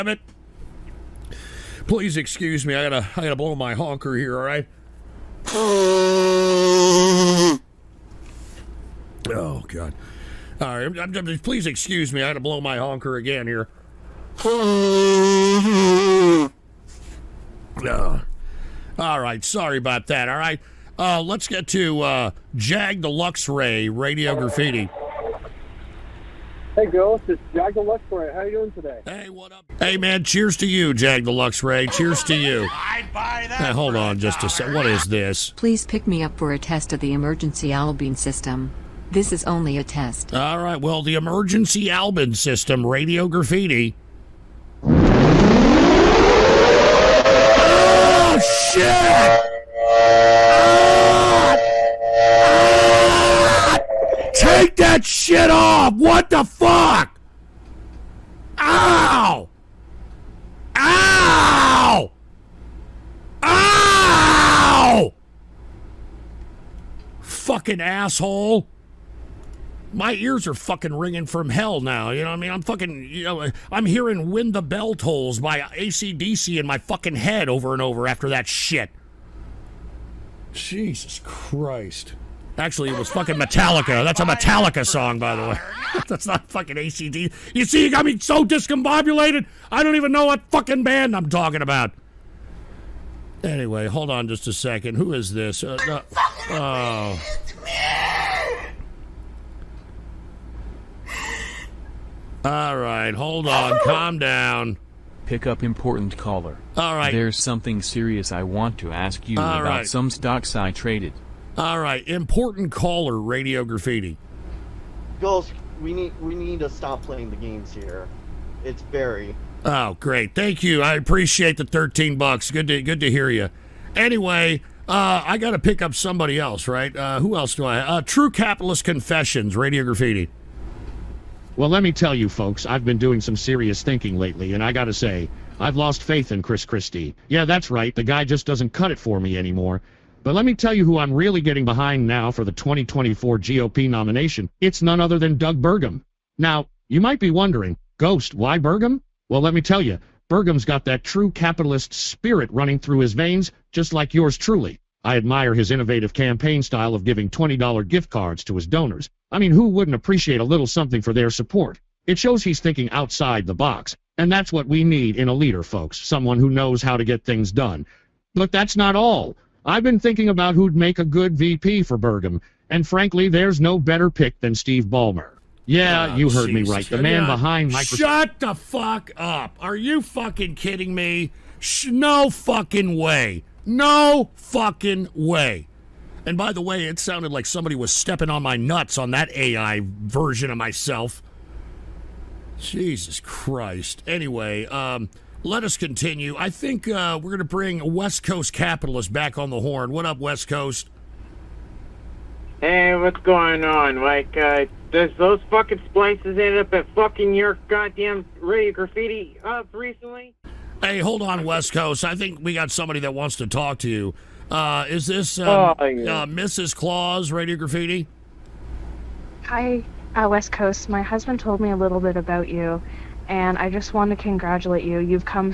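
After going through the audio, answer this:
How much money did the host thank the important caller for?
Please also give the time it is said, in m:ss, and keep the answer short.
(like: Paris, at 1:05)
$13, at 2:01.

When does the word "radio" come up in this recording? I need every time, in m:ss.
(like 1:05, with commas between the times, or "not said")
0:23, 0:42, 1:53, 2:09, 3:28, 3:37.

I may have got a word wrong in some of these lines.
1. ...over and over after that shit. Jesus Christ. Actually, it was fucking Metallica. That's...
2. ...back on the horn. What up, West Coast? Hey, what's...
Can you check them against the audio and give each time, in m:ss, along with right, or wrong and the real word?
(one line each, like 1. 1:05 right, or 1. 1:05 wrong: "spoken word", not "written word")
1. 1:17 right
2. 3:19 right.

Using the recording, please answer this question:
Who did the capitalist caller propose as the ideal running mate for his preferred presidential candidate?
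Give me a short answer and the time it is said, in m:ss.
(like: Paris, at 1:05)
Steve Ballmer, at 2:54.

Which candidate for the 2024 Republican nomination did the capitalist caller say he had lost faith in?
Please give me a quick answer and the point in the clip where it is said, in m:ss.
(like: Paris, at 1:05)
Chris Christie, at 2:16.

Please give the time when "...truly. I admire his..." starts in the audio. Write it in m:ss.
2:34.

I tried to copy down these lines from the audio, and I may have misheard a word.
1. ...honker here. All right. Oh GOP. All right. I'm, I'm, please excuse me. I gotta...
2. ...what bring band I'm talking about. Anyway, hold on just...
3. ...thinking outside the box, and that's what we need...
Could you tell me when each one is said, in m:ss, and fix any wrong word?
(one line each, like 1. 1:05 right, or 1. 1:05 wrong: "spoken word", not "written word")
1. 0:03 wrong: "God", not "GOP"
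2. 1:30 wrong: "fucking", not "bring"
3. 2:42 right.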